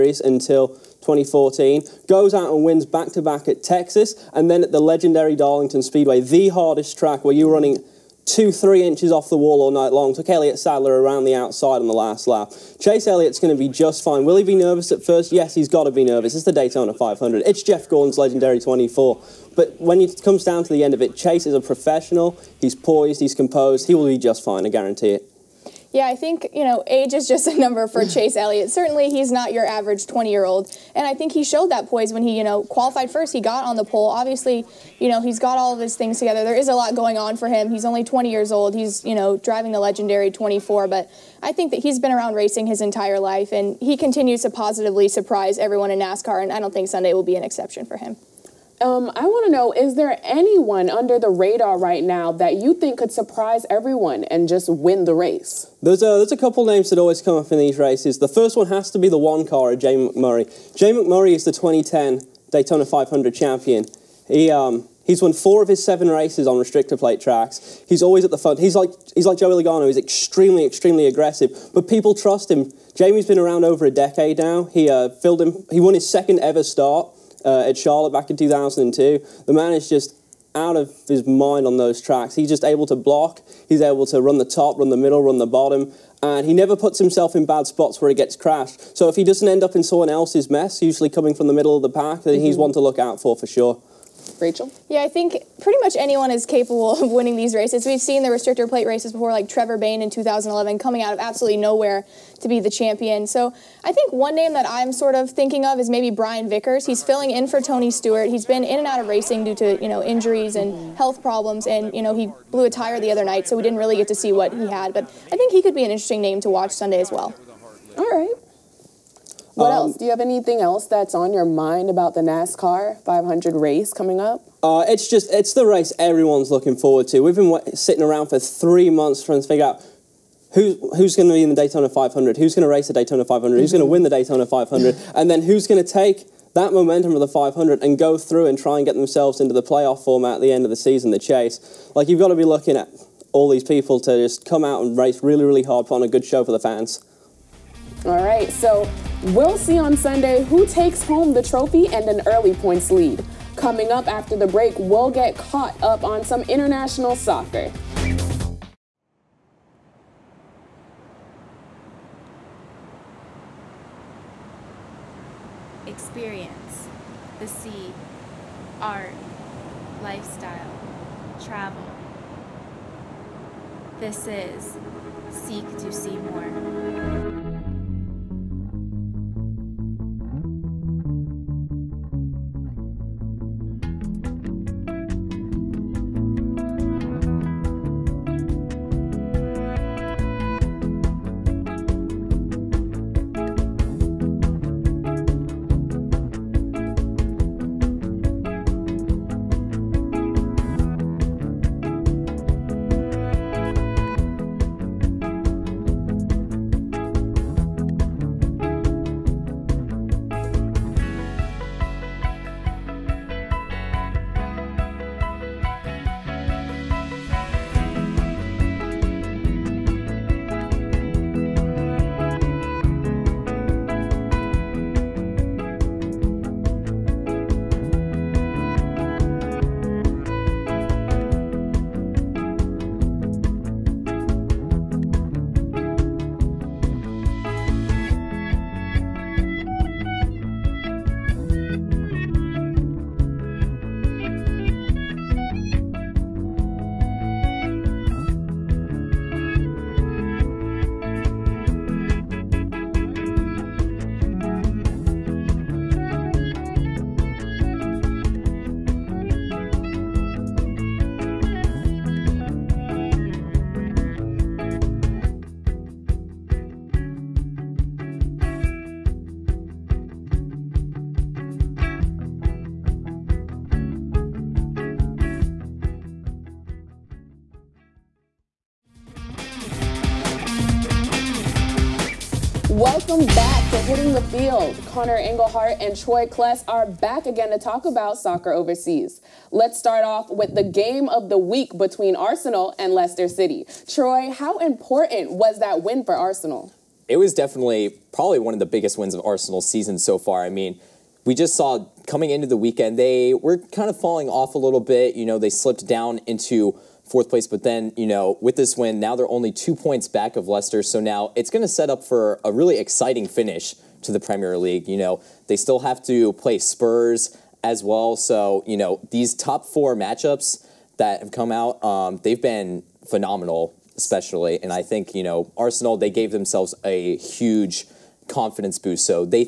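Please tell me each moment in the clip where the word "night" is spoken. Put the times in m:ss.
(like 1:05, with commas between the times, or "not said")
0:09, 1:53.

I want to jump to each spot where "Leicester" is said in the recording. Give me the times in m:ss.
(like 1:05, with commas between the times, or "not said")
4:52, 5:10.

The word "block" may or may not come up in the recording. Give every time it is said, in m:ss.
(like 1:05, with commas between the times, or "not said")
1:22.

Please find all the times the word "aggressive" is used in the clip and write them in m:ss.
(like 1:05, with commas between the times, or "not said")
1:11.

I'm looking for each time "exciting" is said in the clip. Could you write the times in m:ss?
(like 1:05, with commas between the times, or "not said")
5:12.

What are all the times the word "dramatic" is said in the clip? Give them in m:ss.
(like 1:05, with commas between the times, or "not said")
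not said.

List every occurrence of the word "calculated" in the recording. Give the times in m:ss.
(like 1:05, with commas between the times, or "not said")
not said.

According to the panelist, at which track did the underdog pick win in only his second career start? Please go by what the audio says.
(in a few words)
Charlotte.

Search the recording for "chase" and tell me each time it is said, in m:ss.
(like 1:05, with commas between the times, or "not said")
0:12, 0:21, 0:28, 2:21.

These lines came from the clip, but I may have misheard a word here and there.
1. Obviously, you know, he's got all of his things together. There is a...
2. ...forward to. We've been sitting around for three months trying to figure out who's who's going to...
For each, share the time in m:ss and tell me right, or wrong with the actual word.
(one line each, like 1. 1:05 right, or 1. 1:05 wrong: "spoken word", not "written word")
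1. 0:34 right
2. 2:06 right.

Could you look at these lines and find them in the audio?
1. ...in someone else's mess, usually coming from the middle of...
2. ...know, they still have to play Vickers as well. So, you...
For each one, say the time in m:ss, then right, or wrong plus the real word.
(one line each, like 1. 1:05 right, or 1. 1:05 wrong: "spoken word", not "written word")
1. 1:29 right
2. 5:14 wrong: "Spurs", not "Vickers".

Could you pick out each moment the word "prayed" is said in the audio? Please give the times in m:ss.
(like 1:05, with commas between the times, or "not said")
not said.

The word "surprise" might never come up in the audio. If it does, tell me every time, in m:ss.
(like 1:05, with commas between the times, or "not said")
0:45, 0:53.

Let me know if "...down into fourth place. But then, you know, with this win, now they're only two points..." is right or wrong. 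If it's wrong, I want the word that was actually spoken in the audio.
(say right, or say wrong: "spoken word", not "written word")
right.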